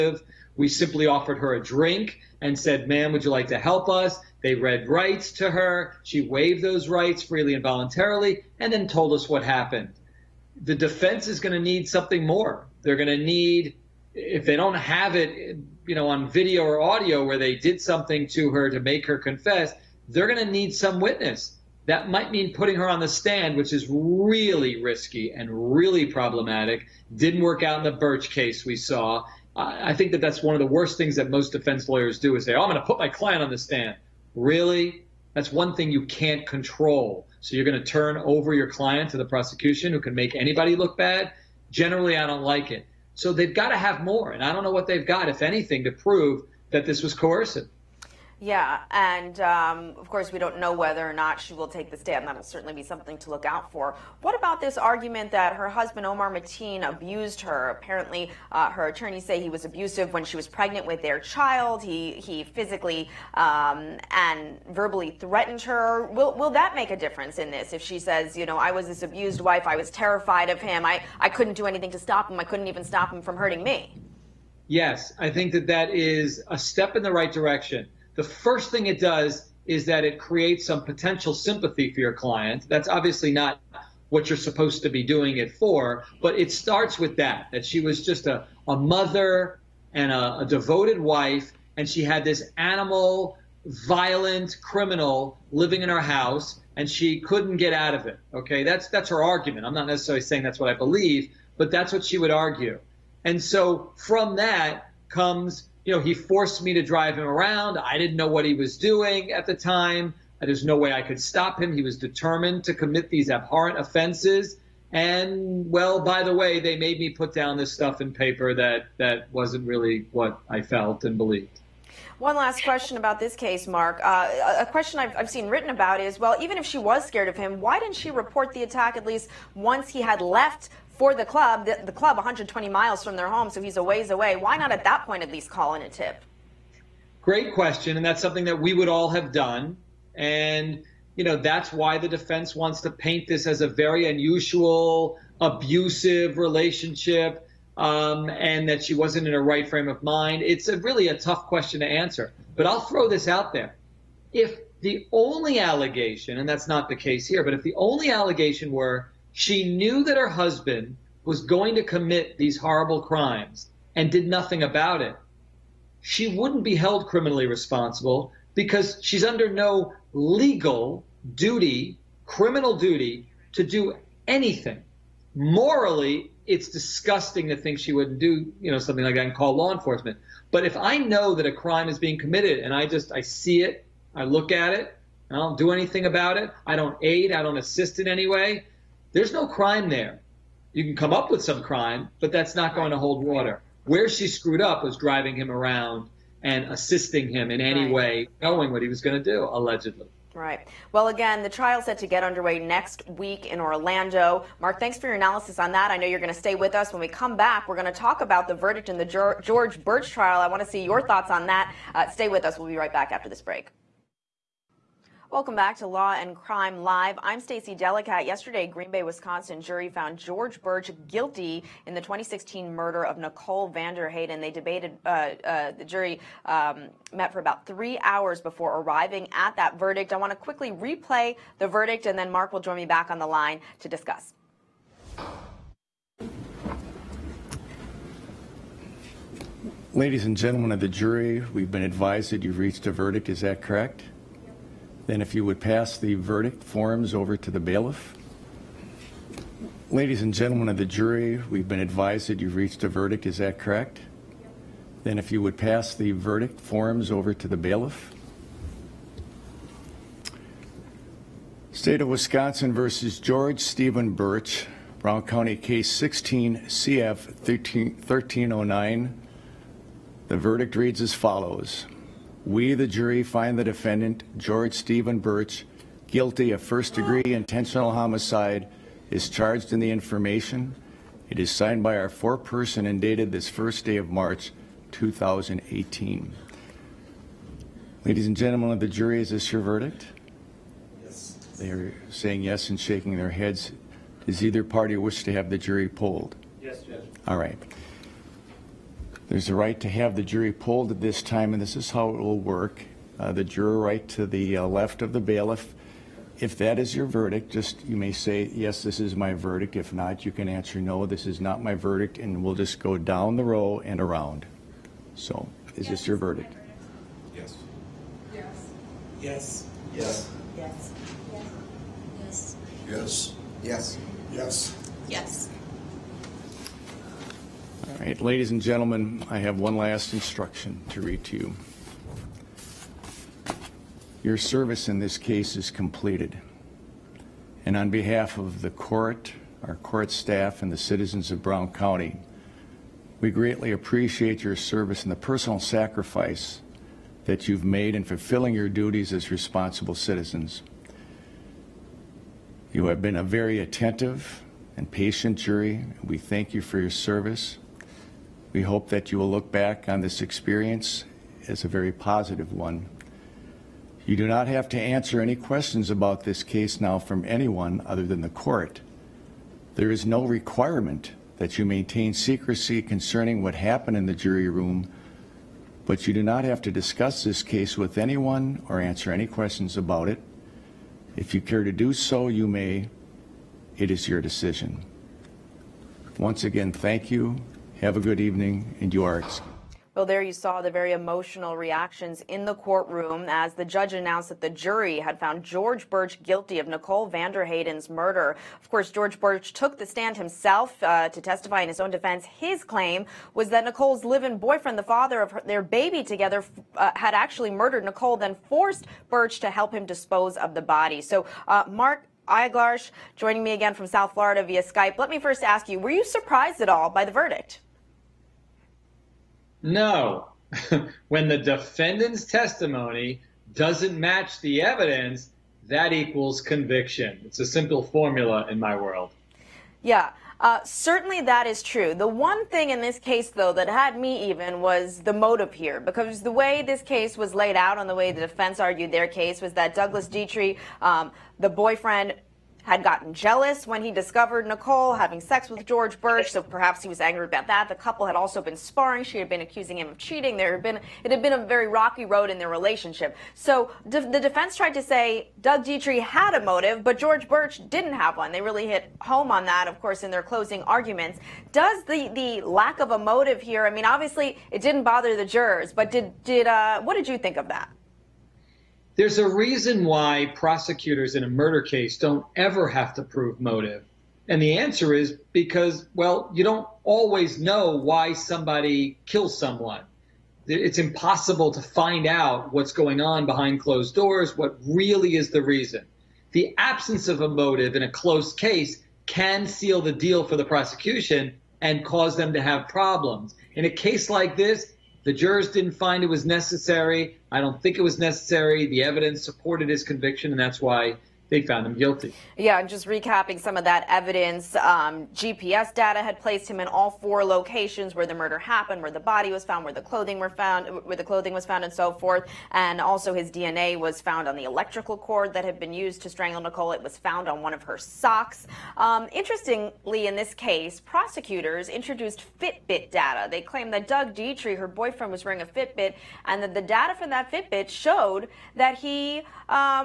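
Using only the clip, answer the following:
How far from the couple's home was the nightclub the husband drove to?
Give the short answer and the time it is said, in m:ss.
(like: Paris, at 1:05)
120 miles, at 2:12.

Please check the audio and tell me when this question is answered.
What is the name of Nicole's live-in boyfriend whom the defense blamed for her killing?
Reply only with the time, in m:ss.
7:19.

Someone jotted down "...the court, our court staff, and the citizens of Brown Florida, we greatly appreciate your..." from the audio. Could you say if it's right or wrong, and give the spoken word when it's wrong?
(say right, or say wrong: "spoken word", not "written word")
wrong: "County", not "Florida".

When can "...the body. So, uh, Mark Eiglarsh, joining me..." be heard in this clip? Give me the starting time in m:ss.
6:50.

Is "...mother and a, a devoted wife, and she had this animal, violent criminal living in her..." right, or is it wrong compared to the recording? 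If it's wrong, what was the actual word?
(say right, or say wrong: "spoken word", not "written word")
right.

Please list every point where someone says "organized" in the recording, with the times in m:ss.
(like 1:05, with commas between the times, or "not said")
not said.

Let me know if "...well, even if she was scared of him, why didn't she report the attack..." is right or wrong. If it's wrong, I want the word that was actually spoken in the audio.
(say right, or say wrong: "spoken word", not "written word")
right.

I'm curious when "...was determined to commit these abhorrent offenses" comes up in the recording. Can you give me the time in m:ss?
1:51.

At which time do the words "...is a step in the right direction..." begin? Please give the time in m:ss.
1:15.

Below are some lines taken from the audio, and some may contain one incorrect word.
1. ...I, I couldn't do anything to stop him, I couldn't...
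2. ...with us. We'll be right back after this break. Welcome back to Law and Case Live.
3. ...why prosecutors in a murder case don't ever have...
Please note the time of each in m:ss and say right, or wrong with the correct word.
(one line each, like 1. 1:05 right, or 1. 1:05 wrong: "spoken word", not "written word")
1. 1:10 right
2. 3:32 wrong: "Crime", not "Case"
3. 7:49 right.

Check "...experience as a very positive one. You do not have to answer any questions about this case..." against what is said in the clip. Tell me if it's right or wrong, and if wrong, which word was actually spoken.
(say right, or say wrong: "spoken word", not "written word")
right.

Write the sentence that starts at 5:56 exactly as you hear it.
We thank you for your service.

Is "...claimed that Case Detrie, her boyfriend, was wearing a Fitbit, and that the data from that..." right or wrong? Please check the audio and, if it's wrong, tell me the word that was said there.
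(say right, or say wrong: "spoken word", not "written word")
wrong: "Doug", not "Case".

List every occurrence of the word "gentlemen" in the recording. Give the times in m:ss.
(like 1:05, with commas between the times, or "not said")
4:00, 4:10, 4:48, 5:28.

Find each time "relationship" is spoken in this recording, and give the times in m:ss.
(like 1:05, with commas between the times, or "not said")
2:26, 7:32.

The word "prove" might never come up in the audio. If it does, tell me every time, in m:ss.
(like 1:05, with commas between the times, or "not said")
0:45, 7:53.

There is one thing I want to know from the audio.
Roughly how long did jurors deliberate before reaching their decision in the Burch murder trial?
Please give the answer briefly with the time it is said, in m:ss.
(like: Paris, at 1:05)
about three hours, at 3:47.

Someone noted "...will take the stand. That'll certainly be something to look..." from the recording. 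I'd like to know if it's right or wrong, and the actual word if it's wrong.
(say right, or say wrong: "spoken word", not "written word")
right.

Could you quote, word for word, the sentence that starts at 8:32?
And also, his DNA was found on the electrical cord that had been used to strangle Nicole.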